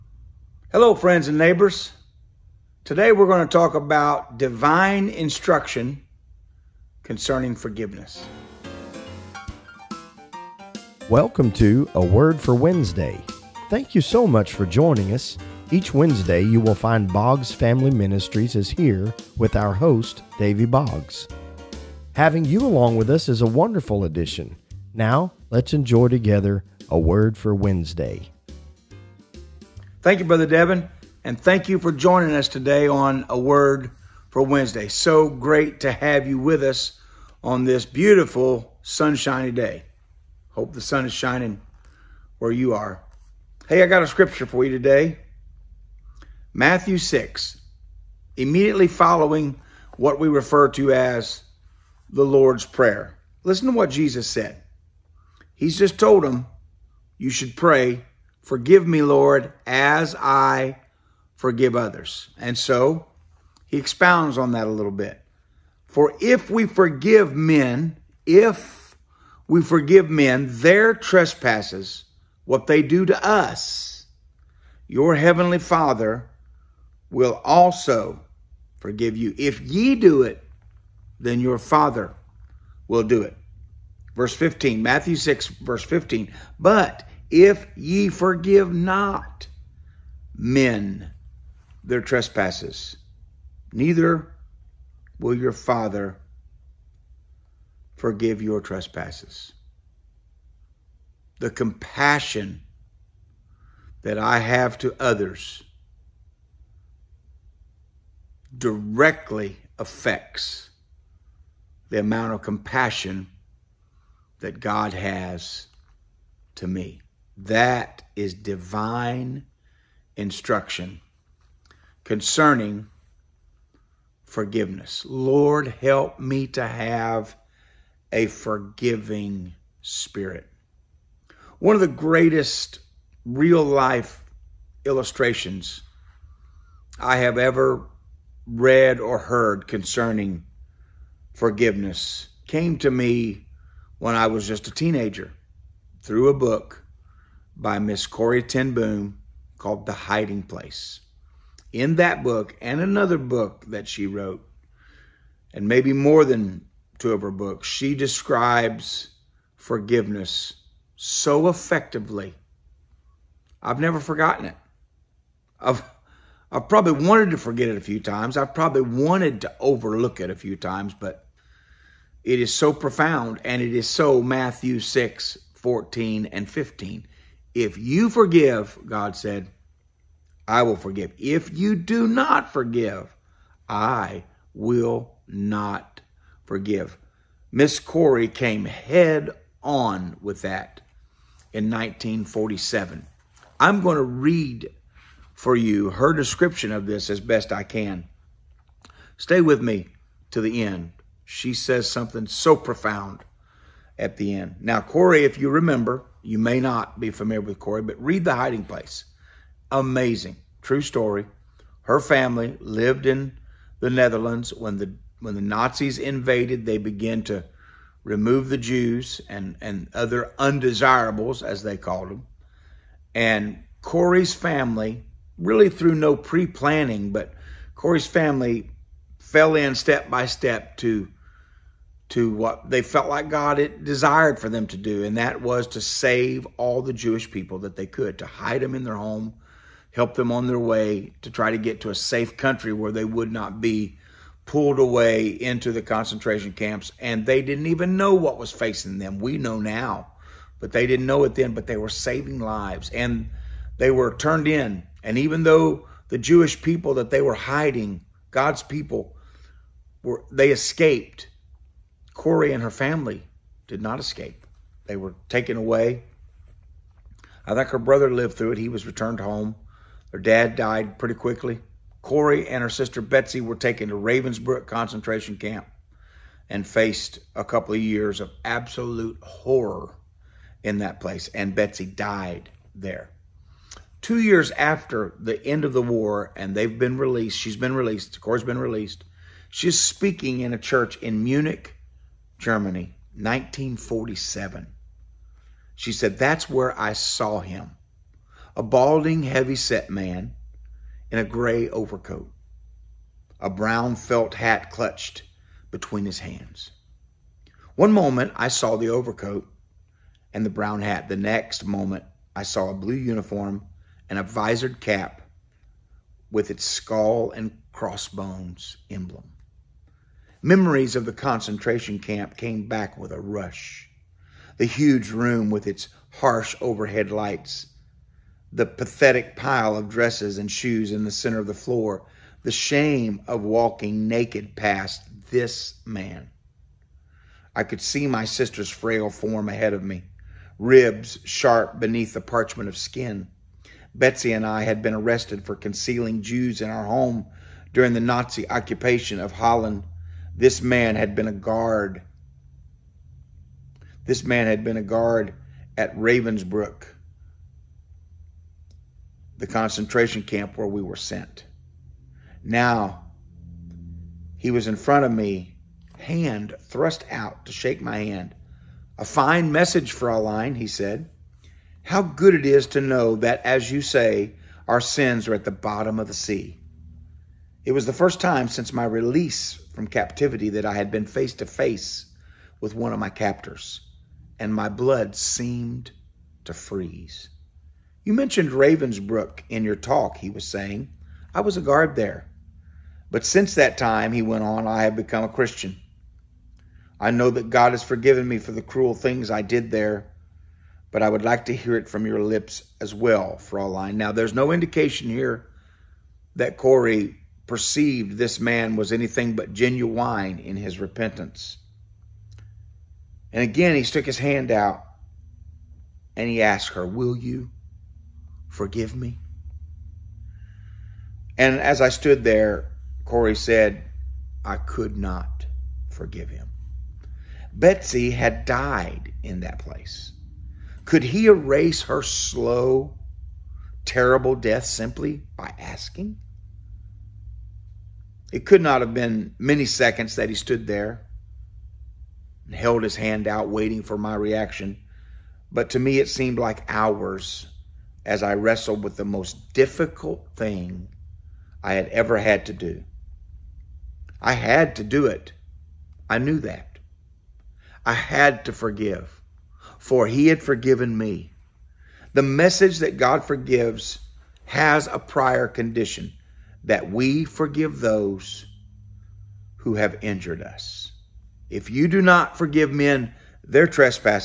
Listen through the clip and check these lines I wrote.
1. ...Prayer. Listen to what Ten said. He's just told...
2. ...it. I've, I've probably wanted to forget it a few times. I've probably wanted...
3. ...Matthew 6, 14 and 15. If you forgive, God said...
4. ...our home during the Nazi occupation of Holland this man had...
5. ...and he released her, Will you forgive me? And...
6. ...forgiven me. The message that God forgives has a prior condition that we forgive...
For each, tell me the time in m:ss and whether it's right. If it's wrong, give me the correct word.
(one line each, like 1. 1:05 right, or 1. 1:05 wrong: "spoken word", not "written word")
1. 0:52 wrong: "Jesus", not "Ten"
2. 2:44 right
3. 2:54 right
4. 5:46 right
5. 6:56 wrong: "asked", not "released"
6. 7:40 right.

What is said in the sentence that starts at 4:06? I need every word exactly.
And they didn't even know what was facing them.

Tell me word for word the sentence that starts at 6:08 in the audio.
A fine message, Fraulein, he said.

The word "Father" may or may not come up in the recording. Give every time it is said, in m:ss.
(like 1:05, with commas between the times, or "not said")
1:15, 1:21, 1:35.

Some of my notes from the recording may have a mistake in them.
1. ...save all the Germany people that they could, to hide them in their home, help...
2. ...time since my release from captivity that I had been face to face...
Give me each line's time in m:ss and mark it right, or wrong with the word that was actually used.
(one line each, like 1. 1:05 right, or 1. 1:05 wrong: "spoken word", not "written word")
1. 3:55 wrong: "Jewish", not "Germany"
2. 6:18 right.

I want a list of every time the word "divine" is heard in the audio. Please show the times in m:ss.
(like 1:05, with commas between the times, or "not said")
0:04, 1:58.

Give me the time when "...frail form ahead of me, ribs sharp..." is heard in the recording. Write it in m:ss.
5:38.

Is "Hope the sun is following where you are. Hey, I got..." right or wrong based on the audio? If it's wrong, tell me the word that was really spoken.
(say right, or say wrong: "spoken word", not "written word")
wrong: "shining", not "following".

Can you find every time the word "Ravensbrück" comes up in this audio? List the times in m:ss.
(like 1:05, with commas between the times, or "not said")
4:33, 5:55, 6:28.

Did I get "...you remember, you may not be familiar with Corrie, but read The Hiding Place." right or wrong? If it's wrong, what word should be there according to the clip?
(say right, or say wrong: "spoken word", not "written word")
right.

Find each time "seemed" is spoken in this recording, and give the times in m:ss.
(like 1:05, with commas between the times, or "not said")
6:25, 7:26.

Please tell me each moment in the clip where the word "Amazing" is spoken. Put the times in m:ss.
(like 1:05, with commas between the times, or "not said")
3:29.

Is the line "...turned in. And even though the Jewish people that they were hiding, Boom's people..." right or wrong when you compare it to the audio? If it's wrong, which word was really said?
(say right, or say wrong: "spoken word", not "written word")
wrong: "God", not "Boom".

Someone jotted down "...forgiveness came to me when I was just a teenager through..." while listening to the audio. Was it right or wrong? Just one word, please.
right.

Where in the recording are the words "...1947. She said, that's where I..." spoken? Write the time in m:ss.
4:53.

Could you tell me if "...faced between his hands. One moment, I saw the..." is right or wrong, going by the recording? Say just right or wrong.
wrong.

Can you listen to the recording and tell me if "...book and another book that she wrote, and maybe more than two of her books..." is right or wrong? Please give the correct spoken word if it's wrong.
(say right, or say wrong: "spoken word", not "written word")
right.